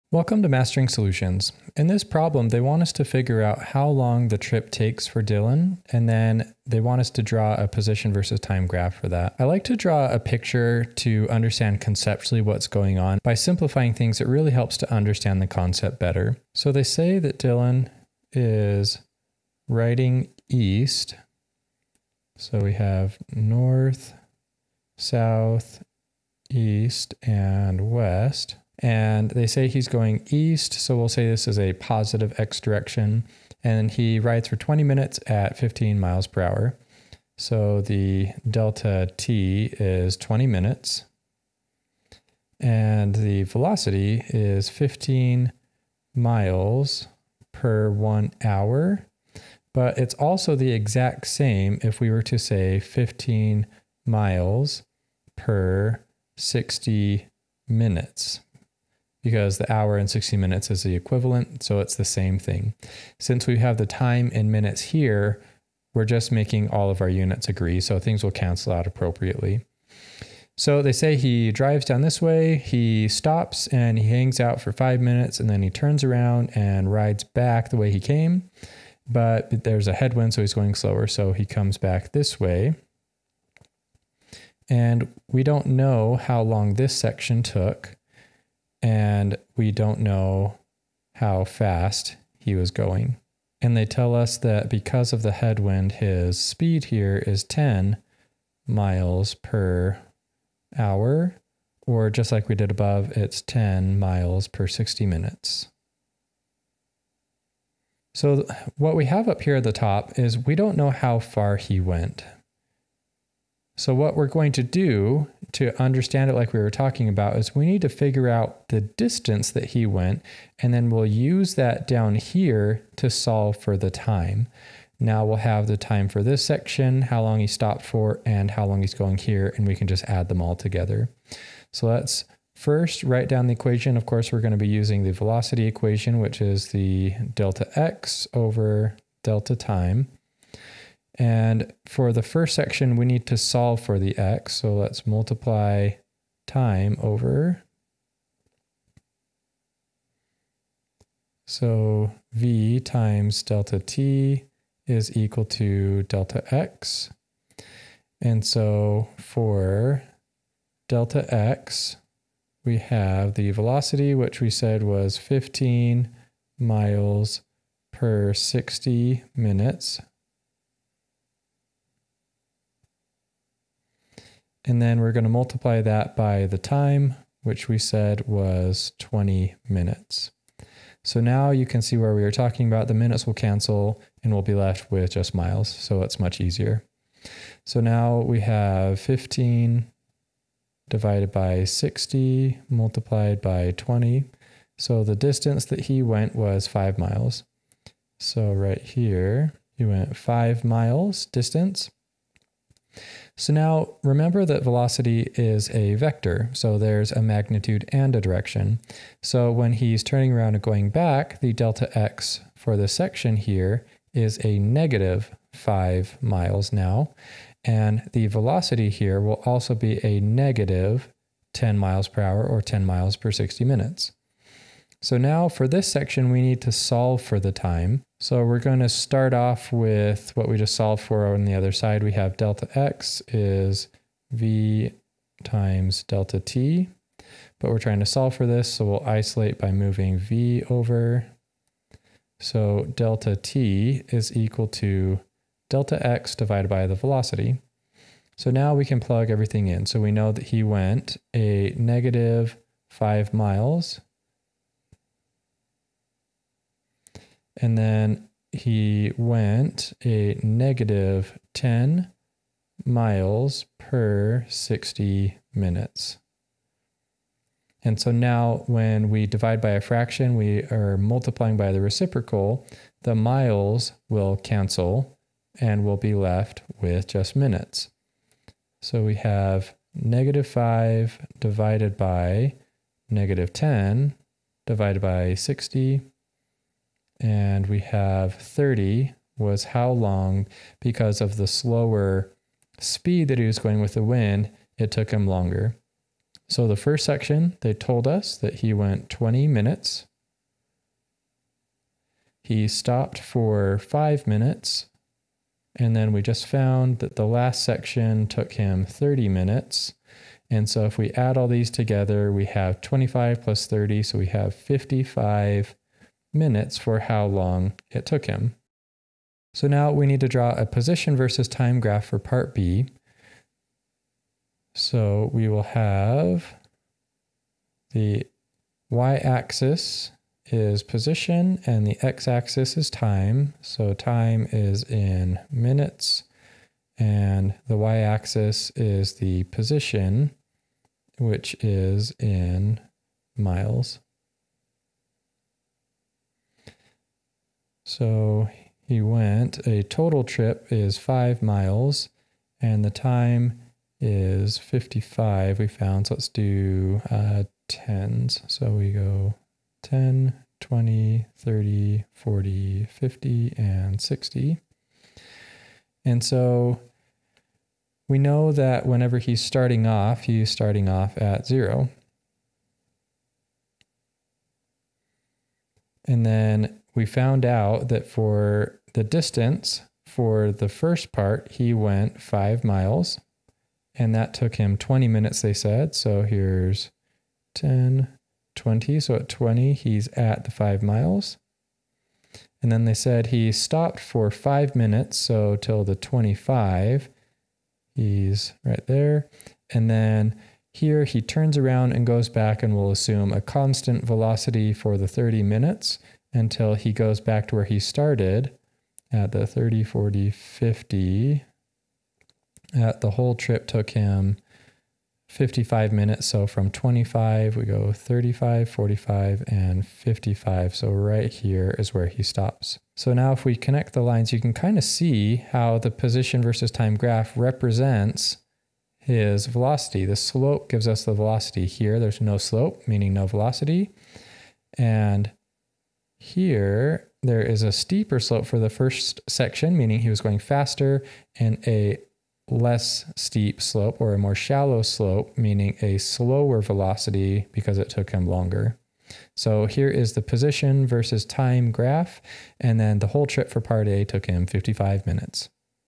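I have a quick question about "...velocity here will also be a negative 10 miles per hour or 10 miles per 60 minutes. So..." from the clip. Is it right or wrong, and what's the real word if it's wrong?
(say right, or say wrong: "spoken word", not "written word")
right.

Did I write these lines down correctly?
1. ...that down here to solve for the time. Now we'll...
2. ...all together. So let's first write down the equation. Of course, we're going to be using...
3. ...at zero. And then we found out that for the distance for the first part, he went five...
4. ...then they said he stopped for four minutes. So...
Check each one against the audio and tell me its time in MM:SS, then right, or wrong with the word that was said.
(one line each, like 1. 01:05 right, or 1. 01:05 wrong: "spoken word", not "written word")
1. 02:01 right
2. 02:10 right
3. 06:11 right
4. 06:32 wrong: "five", not "four".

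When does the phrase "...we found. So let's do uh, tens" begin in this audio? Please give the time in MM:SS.
05:55.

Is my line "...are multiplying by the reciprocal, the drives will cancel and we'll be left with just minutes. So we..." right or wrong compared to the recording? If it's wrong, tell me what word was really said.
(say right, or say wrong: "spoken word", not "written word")
wrong: "miles", not "drives".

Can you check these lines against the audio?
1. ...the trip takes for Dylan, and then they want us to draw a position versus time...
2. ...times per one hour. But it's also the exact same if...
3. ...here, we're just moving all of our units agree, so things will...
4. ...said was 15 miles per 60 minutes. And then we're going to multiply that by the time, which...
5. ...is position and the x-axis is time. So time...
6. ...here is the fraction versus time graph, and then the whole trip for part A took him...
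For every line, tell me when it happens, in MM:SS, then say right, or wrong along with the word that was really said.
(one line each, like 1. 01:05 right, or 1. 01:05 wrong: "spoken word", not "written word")
1. 00:04 right
2. 00:46 wrong: "miles", not "times"
3. 01:04 wrong: "making", not "moving"
4. 02:44 right
5. 05:30 right
6. 07:29 wrong: "position", not "fraction".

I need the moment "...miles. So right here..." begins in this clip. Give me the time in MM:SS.
03:16.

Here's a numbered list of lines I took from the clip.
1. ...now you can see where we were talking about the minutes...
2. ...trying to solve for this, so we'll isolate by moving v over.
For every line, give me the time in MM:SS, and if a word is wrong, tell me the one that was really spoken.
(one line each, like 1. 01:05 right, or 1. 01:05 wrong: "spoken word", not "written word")
1. 03:01 right
2. 03:57 right.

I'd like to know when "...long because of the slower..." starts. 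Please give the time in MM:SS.
04:49.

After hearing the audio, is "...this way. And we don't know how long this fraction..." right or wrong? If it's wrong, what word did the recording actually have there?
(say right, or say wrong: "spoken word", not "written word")
wrong: "section", not "fraction".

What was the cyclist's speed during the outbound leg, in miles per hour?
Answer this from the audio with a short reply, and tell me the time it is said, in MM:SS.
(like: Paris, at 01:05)
15, at 00:35.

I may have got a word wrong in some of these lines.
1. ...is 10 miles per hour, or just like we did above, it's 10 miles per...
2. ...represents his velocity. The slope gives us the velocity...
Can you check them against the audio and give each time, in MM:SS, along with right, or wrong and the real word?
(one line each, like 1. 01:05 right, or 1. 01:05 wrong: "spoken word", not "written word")
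1. 01:37 right
2. 07:07 right.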